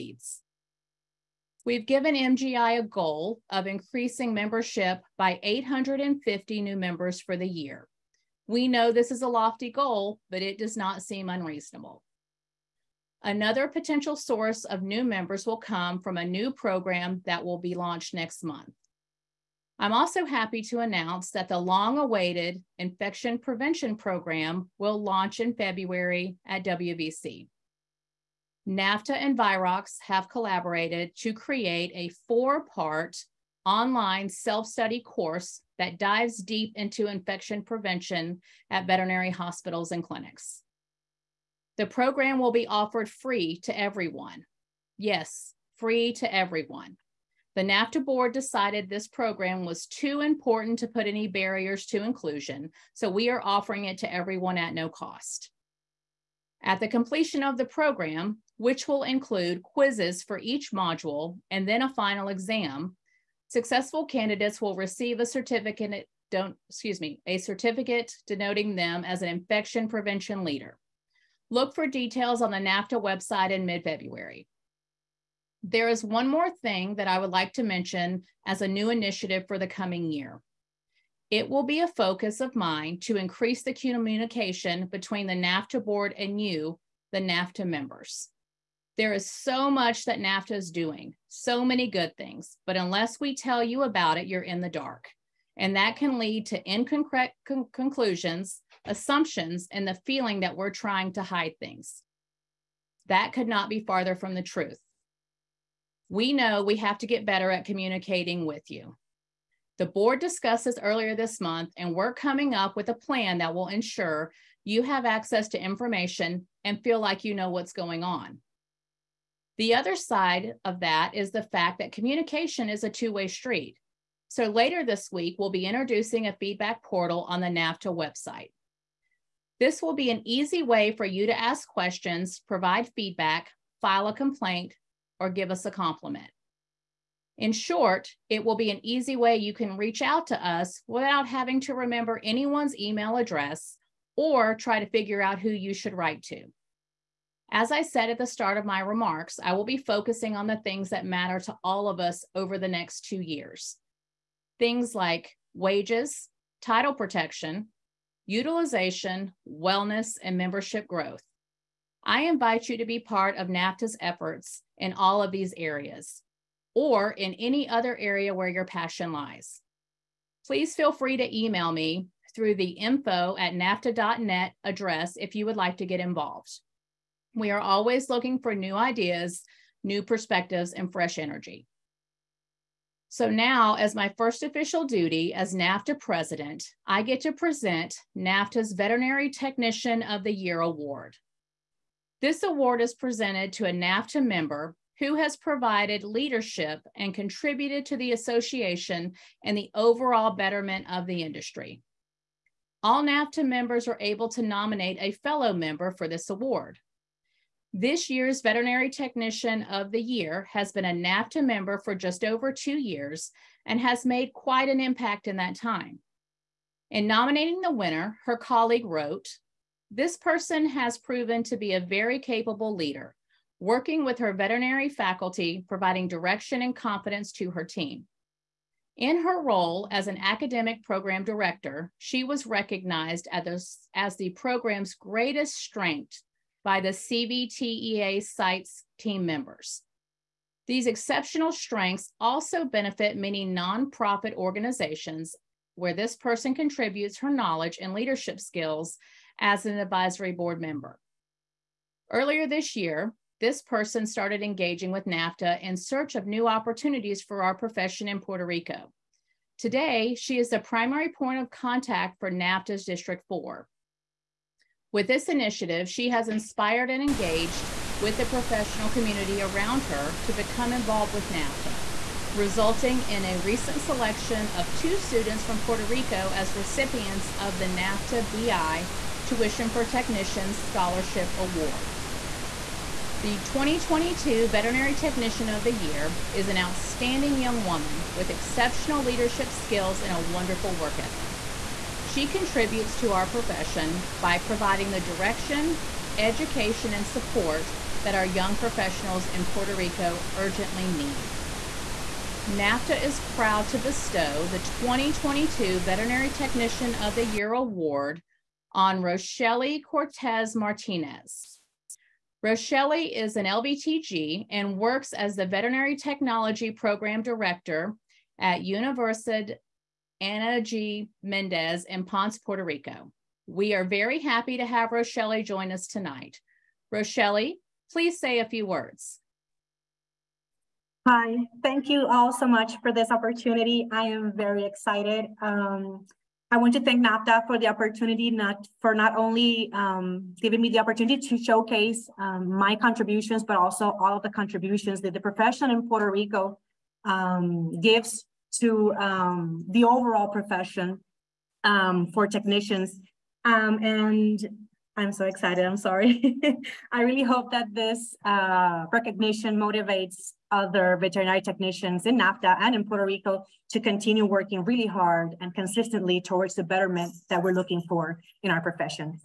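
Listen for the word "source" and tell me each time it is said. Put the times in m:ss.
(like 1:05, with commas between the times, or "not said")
0:14.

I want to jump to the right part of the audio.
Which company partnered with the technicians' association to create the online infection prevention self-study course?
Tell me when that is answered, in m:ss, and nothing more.
0:29.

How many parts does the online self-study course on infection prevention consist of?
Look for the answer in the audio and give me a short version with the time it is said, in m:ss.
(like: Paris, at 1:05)
4, at 0:32.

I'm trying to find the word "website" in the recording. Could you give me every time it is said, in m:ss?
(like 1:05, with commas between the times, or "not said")
1:13, 2:07.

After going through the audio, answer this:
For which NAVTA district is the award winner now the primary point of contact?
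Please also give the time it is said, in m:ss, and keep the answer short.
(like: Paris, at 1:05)
District 4, at 4:22.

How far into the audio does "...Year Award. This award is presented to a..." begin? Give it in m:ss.
3:10.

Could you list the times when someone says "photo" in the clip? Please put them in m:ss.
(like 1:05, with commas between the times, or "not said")
not said.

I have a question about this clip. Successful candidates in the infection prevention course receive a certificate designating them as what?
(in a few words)
infection prevention leader.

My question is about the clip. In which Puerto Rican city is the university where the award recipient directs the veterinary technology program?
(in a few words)
Ponce.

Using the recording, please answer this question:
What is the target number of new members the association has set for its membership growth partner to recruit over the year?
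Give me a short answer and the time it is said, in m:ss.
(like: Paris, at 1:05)
850, at 0:05.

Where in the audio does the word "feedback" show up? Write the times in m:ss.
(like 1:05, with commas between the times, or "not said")
2:06, 2:12.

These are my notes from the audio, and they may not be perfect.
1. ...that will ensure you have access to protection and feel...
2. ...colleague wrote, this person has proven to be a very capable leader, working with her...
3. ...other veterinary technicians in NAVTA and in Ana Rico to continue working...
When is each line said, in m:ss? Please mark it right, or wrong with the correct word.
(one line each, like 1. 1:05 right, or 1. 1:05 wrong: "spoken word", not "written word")
1. 1:53 wrong: "information", not "protection"
2. 3:38 right
3. 6:00 wrong: "Puerto", not "Ana".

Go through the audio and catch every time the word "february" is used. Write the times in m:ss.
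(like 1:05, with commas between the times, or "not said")
0:25, 1:13.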